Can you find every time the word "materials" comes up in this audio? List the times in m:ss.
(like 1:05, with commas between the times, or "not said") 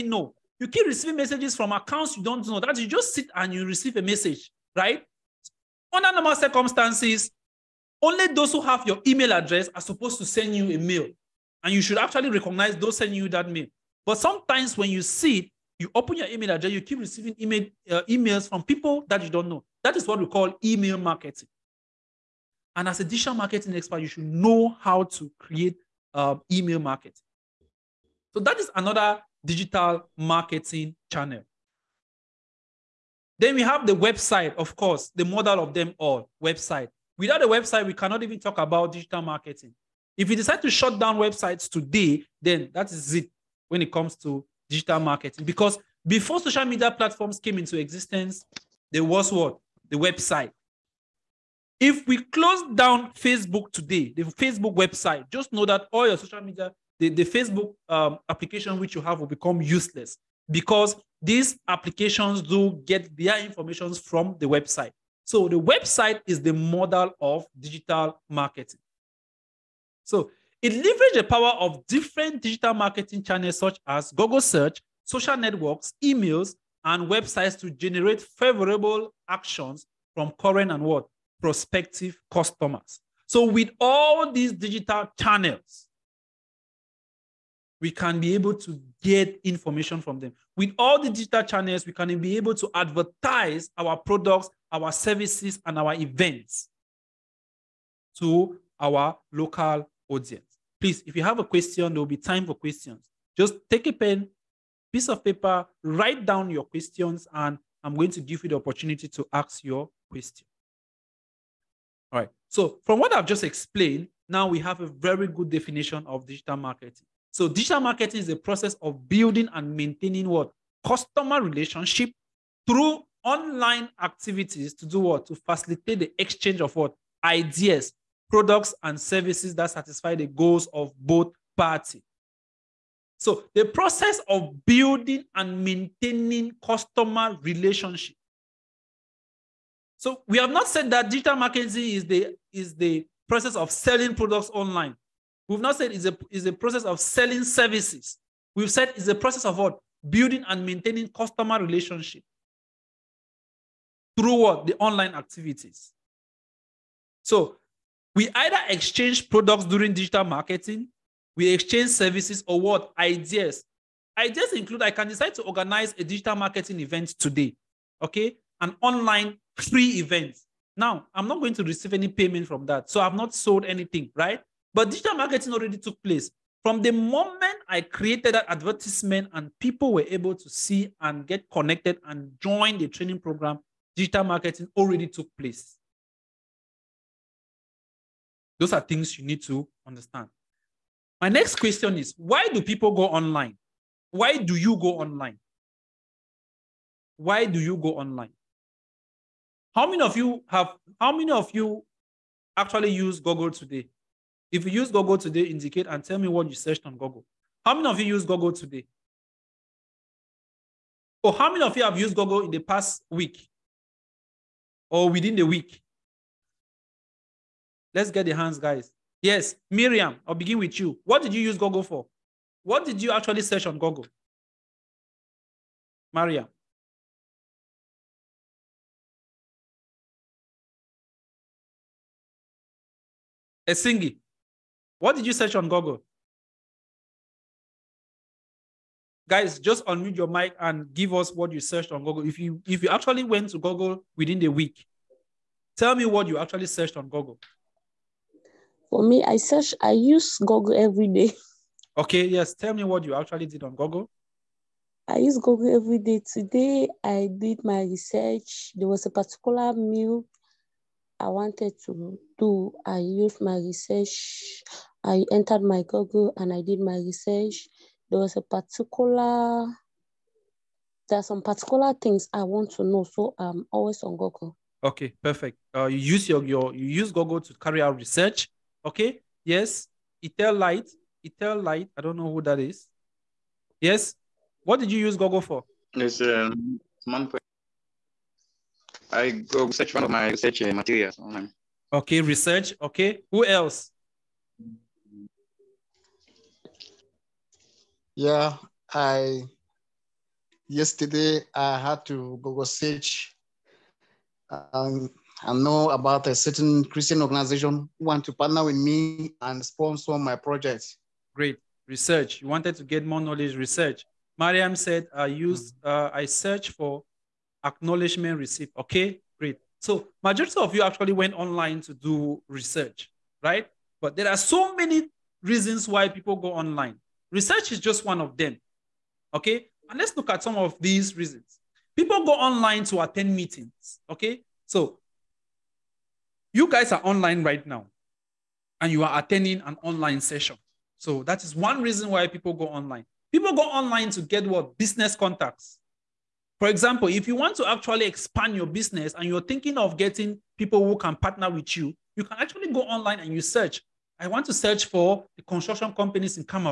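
4:50.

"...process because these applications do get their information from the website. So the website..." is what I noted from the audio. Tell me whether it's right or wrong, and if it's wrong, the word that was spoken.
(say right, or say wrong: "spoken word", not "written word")
wrong: "useless", not "process".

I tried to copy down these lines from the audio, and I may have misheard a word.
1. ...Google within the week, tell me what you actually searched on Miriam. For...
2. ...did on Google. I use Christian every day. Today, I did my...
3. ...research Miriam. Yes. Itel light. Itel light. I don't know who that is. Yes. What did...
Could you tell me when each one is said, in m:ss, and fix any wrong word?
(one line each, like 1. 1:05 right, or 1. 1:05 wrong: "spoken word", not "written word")
1. 4:03 wrong: "Google", not "Miriam"
2. 4:13 wrong: "Google", not "Christian"
3. 4:37 wrong: "Okay", not "Miriam".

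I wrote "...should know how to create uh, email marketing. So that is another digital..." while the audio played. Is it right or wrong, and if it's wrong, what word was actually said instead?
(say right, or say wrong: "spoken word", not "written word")
right.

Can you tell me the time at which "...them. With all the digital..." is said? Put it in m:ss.
1:30.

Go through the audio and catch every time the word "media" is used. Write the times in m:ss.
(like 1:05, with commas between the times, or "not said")
0:46, 0:56.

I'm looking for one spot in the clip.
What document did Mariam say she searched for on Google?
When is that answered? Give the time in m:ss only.
5:17.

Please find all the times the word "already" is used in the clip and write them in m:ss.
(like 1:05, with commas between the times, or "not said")
2:55, 3:04.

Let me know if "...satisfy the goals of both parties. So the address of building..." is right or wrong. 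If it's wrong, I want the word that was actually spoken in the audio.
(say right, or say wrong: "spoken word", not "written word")
wrong: "process", not "address".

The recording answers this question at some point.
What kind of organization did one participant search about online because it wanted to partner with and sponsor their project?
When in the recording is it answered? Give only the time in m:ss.
5:06.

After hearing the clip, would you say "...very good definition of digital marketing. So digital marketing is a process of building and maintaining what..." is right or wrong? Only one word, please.
right.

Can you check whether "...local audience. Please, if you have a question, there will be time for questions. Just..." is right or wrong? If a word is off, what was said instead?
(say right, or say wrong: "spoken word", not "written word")
right.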